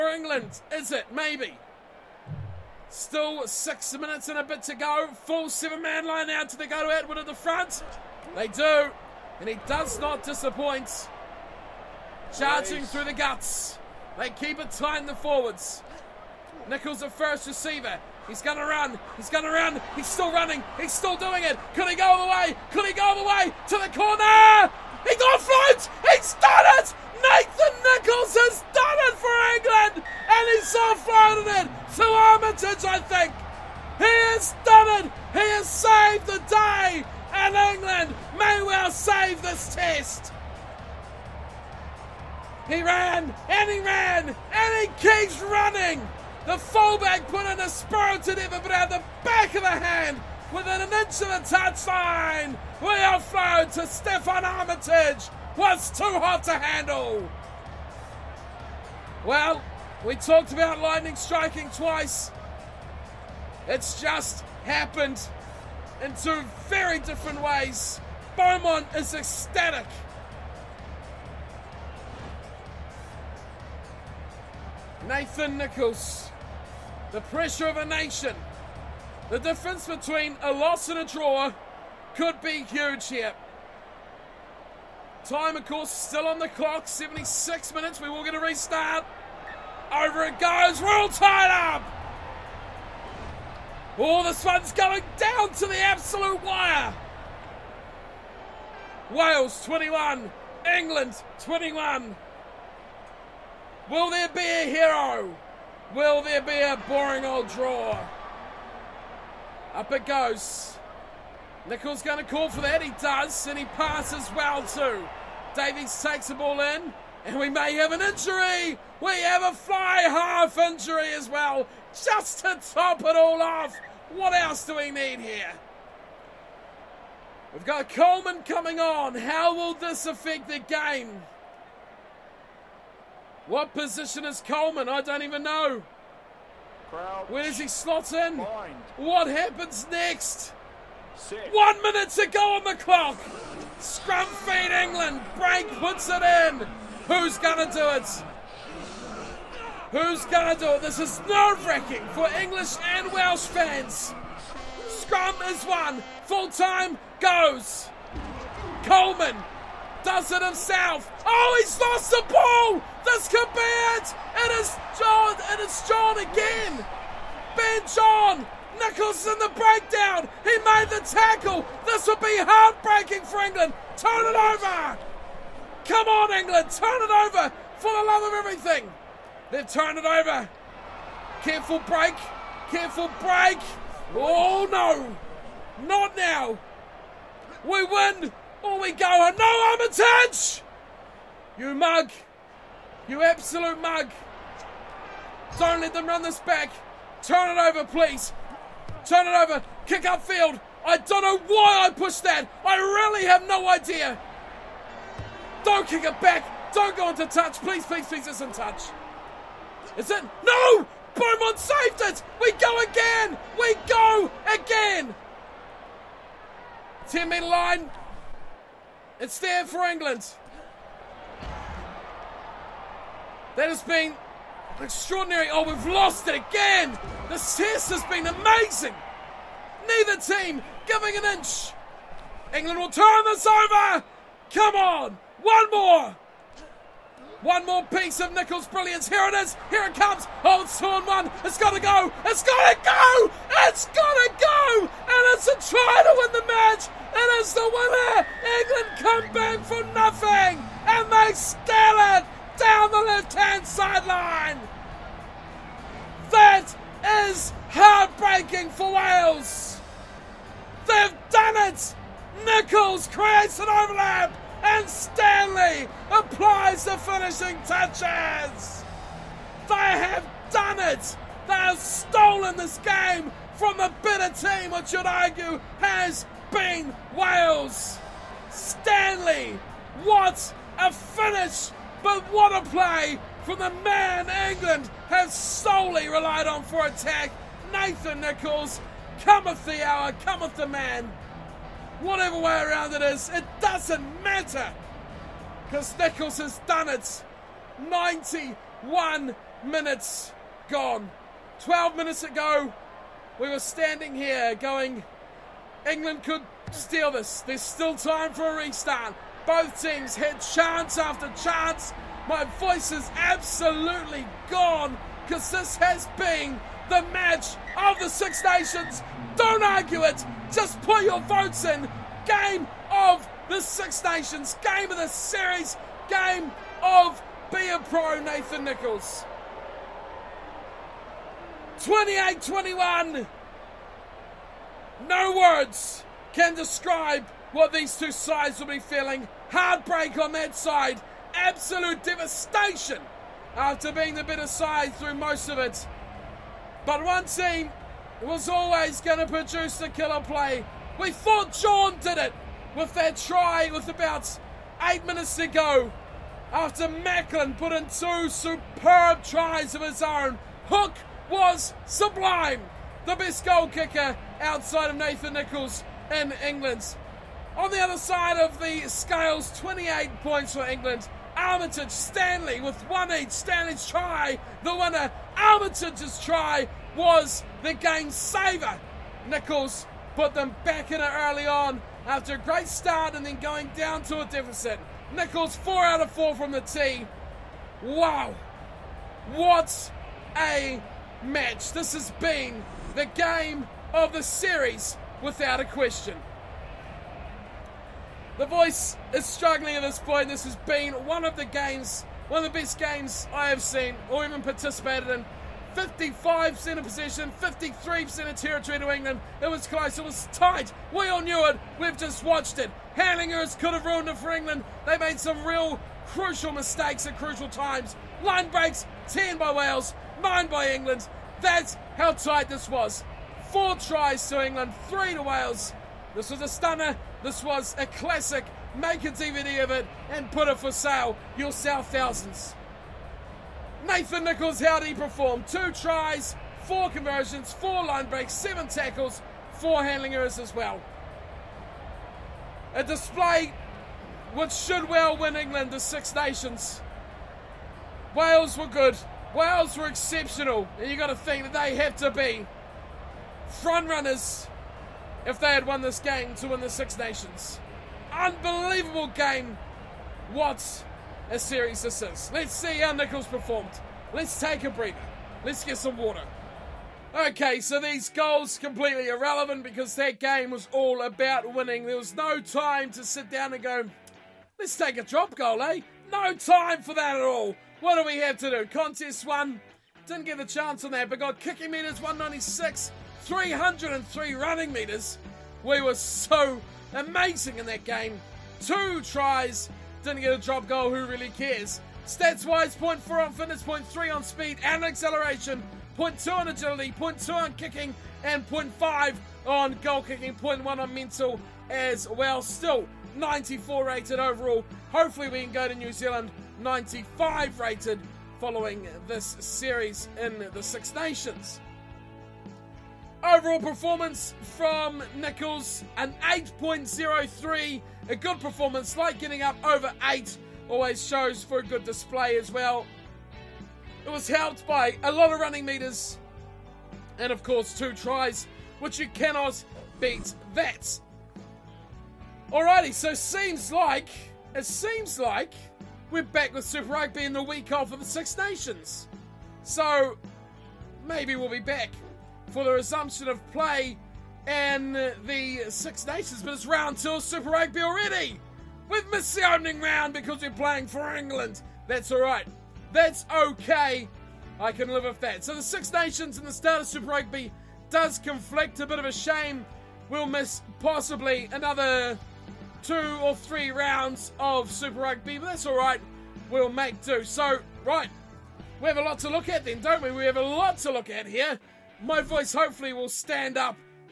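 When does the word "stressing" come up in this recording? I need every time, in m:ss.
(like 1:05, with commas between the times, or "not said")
not said.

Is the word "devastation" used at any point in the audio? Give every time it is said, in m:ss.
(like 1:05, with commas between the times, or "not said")
5:42.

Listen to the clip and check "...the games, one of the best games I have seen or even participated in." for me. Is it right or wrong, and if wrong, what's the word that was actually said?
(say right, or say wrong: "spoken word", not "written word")
right.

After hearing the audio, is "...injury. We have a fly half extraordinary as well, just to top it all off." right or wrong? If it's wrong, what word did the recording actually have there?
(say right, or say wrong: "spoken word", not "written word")
wrong: "injury", not "extraordinary".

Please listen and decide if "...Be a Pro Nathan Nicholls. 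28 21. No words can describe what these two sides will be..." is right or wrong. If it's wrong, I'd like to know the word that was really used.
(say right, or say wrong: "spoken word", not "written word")
right.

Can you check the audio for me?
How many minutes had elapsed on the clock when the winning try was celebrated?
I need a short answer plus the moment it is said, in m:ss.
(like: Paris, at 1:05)
91, at 4:57.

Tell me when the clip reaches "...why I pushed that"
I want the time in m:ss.
3:21.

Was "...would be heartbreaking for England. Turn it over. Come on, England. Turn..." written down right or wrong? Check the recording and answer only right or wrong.
right.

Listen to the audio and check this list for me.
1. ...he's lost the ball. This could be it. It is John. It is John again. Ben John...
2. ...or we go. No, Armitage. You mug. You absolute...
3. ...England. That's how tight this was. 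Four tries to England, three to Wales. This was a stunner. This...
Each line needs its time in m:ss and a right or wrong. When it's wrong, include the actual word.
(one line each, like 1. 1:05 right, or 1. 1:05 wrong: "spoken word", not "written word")
1. 2:41 right
2. 3:08 right
3. 7:00 right.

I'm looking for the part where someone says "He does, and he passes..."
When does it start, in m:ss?
1:52.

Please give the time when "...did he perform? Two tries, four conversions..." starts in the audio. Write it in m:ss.
7:14.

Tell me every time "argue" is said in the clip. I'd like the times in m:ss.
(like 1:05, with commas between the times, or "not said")
4:35, 5:19.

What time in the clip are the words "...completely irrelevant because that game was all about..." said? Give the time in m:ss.
7:48.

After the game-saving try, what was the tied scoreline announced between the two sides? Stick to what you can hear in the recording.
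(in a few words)
Wales 21, England 21.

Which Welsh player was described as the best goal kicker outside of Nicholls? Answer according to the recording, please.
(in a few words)
Hook.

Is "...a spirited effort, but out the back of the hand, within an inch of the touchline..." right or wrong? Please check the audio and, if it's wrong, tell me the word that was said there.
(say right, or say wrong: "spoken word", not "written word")
right.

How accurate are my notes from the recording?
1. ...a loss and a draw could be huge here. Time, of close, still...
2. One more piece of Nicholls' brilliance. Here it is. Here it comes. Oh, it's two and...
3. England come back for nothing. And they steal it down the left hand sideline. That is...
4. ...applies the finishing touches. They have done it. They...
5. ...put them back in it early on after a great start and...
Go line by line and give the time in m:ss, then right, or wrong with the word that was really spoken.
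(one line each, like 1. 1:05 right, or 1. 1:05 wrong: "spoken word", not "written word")
1. 1:20 wrong: "course", not "close"
2. 3:57 right
3. 4:08 right
4. 4:26 right
5. 6:20 right.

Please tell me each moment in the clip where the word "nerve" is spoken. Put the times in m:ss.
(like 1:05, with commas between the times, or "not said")
2:31.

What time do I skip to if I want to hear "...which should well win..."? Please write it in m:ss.
7:24.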